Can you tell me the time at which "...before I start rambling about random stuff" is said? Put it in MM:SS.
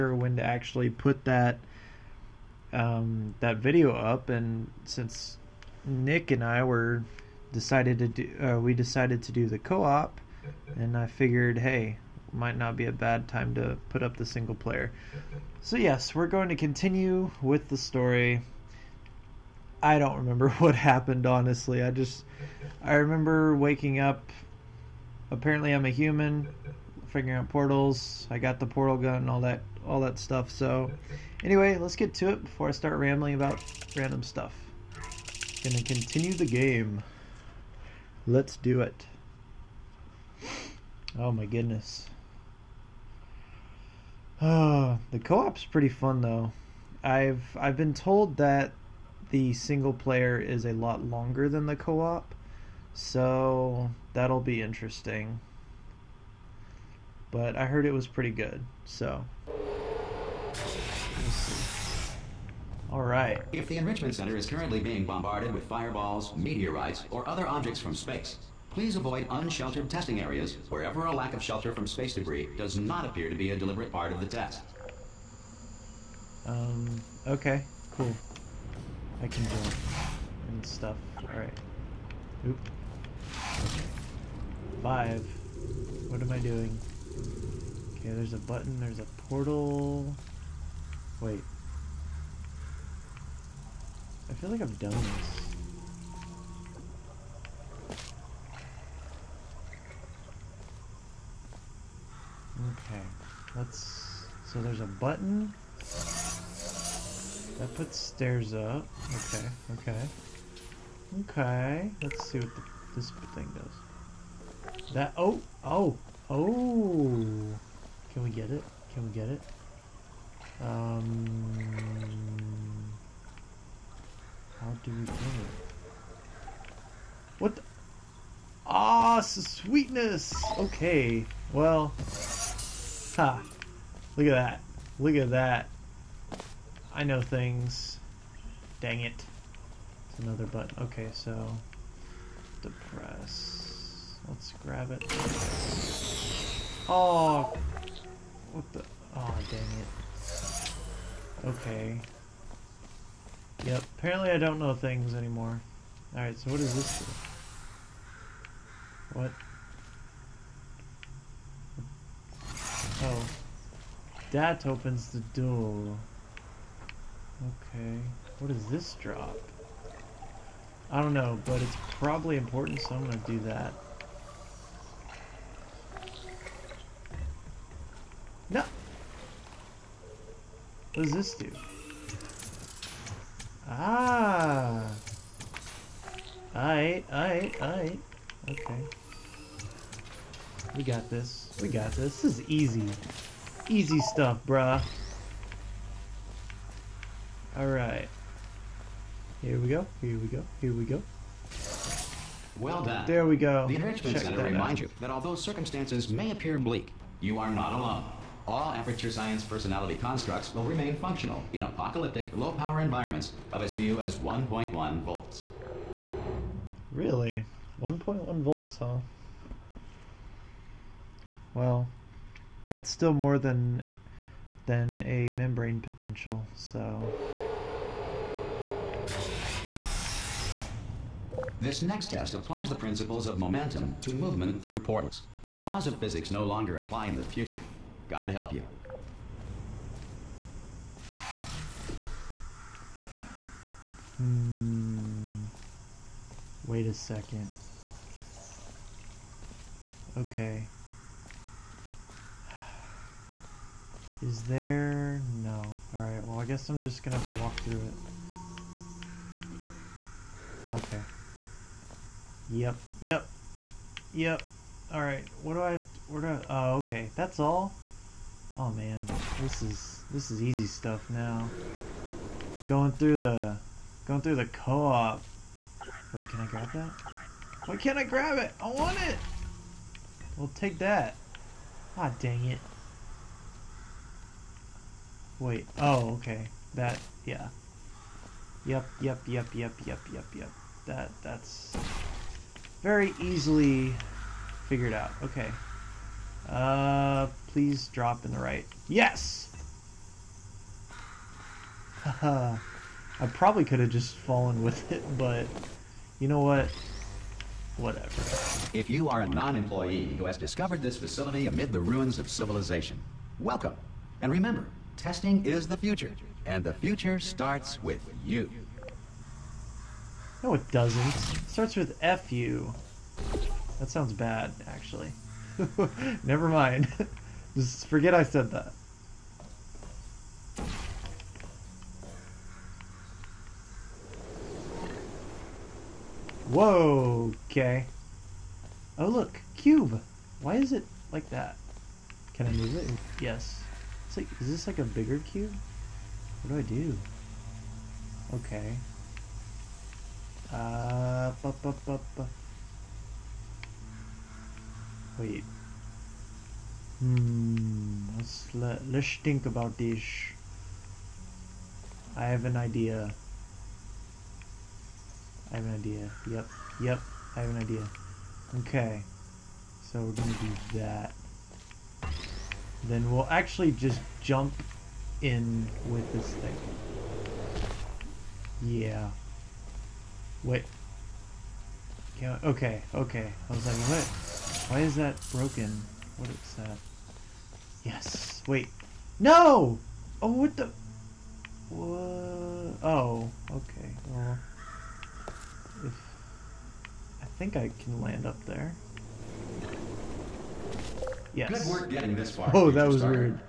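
00:32.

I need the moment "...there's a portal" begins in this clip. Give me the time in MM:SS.
01:28.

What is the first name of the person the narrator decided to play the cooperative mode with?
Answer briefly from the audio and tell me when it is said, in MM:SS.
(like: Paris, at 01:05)
Nick, at 00:05.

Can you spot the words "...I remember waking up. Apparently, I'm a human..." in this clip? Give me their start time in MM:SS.
00:22.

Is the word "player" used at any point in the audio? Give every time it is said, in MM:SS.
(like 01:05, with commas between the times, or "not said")
00:14, 00:49.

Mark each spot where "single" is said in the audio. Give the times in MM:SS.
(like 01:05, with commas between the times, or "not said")
00:14, 00:49.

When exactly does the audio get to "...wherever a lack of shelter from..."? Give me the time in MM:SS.
01:10.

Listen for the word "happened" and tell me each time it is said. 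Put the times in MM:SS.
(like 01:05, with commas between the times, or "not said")
00:20.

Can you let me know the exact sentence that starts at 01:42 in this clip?
Okay, let's, so there's a button, that puts stairs up.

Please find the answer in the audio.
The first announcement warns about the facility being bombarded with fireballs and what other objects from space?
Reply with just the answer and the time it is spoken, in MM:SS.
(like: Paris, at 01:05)
meteorites, at 01:06.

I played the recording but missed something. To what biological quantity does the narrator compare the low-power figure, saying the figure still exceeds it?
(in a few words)
membrane potential.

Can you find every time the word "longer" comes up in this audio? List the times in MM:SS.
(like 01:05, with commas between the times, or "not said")
00:51, 03:56.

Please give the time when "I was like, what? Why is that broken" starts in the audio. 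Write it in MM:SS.
06:23.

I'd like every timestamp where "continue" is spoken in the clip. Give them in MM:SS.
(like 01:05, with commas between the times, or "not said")
00:16, 00:35.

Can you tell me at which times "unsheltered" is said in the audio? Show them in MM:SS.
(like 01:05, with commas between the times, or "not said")
01:09.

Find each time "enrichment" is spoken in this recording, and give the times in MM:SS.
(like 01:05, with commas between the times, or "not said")
01:03, 03:23.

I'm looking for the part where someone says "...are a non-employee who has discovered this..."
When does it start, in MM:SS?
05:09.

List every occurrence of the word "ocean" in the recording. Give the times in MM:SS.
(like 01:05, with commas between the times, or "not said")
not said.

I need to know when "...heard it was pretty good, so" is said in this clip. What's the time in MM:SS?
00:57.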